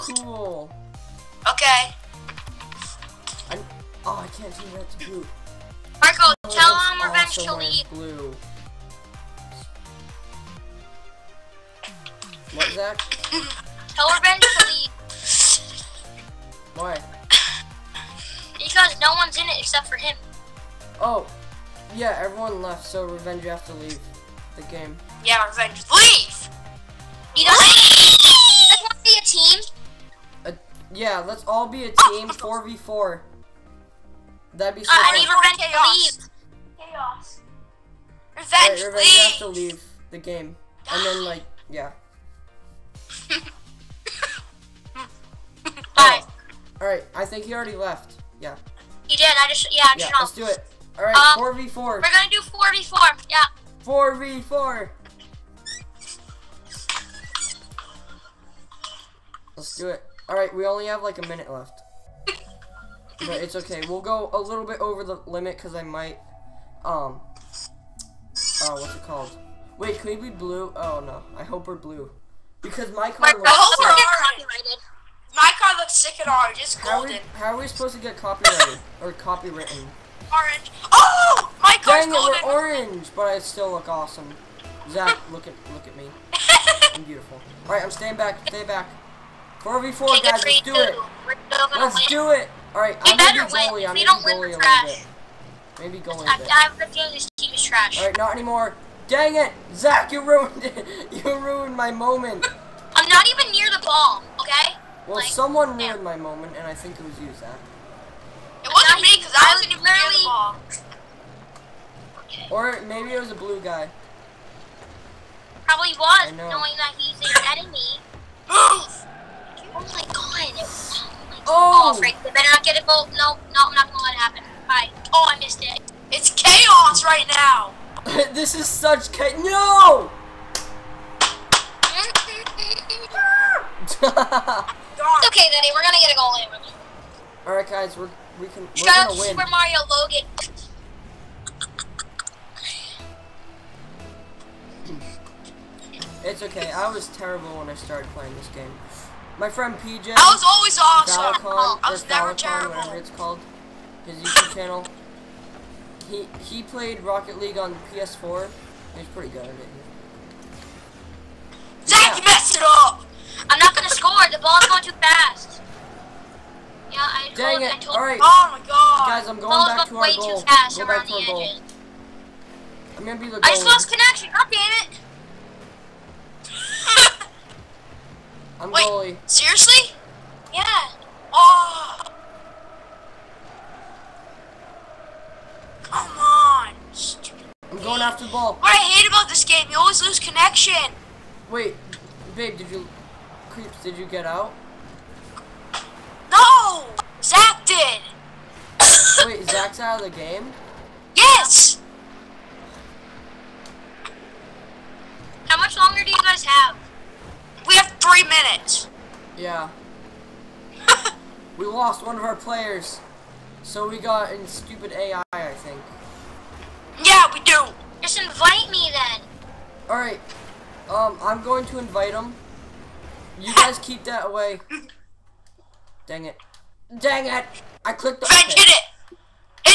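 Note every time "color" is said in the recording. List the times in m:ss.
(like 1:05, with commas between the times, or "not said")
1:13.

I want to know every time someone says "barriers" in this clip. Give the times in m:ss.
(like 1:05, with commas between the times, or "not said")
not said.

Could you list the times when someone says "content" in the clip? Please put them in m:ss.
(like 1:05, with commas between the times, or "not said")
not said.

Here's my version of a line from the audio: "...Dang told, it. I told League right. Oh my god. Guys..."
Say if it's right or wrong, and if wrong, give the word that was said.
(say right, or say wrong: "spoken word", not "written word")
wrong: "All", not "League".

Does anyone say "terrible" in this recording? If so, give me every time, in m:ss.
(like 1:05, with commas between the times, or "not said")
2:27, 2:32.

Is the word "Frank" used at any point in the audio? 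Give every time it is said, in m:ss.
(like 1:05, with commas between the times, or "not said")
2:01, 3:48.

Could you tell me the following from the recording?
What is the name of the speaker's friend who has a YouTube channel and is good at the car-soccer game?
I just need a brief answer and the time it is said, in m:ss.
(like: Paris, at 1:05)
PJ, at 2:29.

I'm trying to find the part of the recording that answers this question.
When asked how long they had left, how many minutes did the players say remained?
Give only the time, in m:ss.
3:27.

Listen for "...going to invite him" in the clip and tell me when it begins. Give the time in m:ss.
3:41.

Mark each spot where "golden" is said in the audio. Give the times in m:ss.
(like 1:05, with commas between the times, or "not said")
1:16, 1:22.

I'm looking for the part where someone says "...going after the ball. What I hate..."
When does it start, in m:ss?
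3:07.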